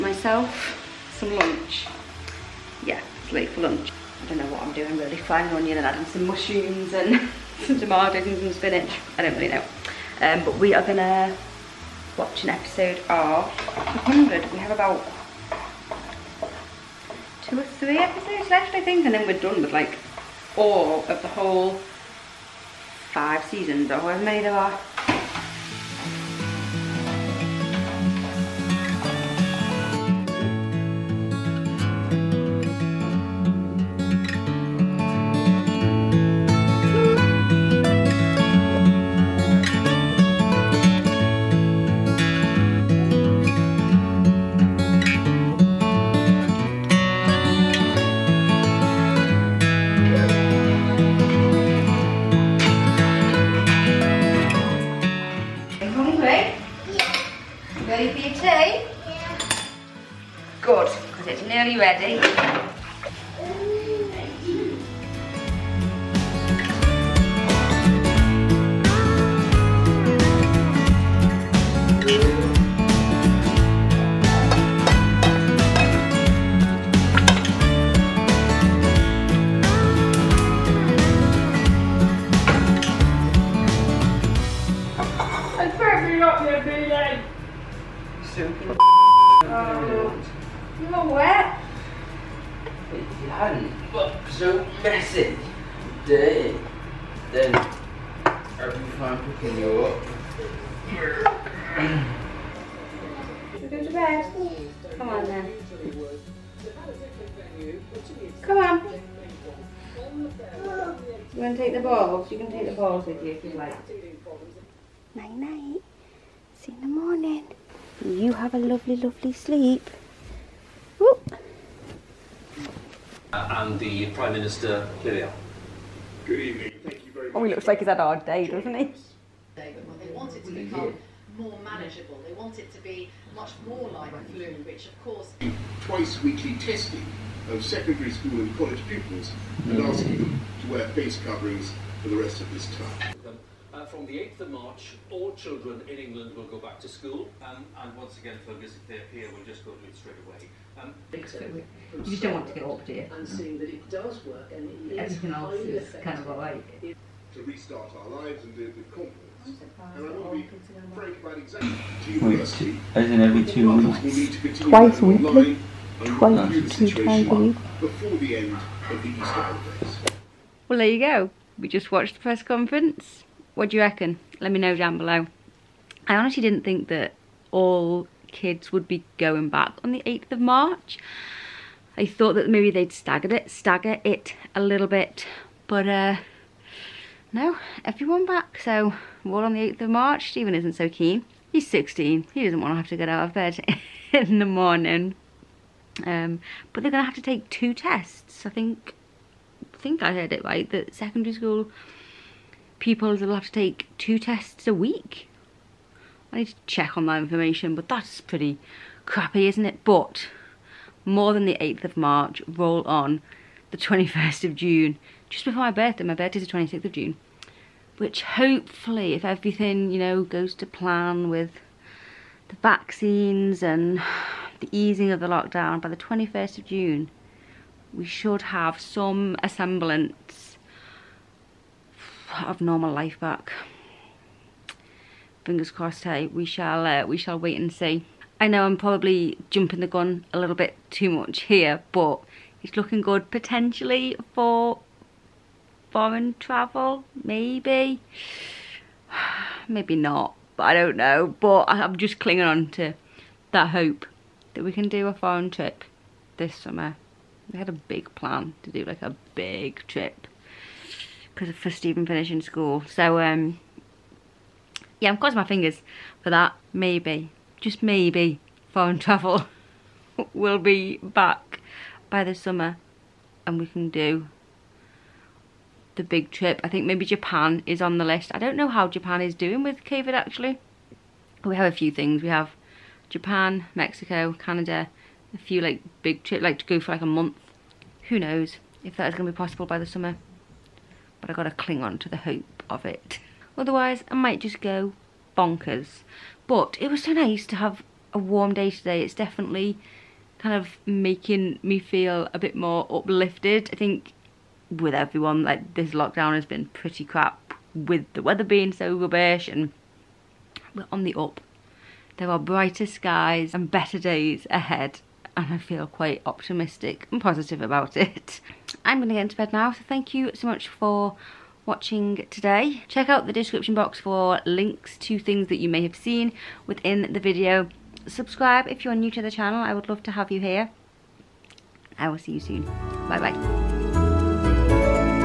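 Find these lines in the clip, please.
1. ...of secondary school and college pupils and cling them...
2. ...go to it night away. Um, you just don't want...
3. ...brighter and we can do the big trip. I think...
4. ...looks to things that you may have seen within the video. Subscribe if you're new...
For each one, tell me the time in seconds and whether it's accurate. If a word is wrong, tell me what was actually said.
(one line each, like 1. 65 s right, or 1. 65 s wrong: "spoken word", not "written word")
1. 137 s wrong: "asking", not "cling"
2. 149 s wrong: "straight", not "night"
3. 272 s wrong: "summer", not "brighter"
4. 324 s wrong: "links", not "looks".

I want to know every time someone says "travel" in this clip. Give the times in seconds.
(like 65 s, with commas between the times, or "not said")
246 s, 268 s.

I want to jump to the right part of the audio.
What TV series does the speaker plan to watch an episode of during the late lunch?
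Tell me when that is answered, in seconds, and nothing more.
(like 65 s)
14 s.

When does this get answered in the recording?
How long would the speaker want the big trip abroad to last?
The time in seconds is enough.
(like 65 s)
287 s.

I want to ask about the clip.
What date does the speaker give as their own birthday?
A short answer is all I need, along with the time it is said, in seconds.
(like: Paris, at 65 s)
26th of June, at 216 s.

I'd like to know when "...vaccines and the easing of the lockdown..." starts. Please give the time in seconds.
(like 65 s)
222 s.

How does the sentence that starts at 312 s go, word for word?
There are brighter skies and better days ahead and I feel quite optimistic and positive about it.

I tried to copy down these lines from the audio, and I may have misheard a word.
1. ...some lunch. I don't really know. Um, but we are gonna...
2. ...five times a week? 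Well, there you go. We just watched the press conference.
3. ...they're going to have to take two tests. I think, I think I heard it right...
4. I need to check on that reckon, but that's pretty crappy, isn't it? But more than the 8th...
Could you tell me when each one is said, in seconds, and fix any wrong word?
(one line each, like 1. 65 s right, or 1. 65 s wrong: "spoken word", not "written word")
1. 8 s wrong: "spinach", not "lunch"
2. 166 s wrong: "two", not "five"
3. 196 s right
4. 206 s wrong: "information", not "reckon".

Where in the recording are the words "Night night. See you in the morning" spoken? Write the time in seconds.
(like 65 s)
115 s.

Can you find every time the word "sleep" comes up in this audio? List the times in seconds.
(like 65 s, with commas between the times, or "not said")
119 s.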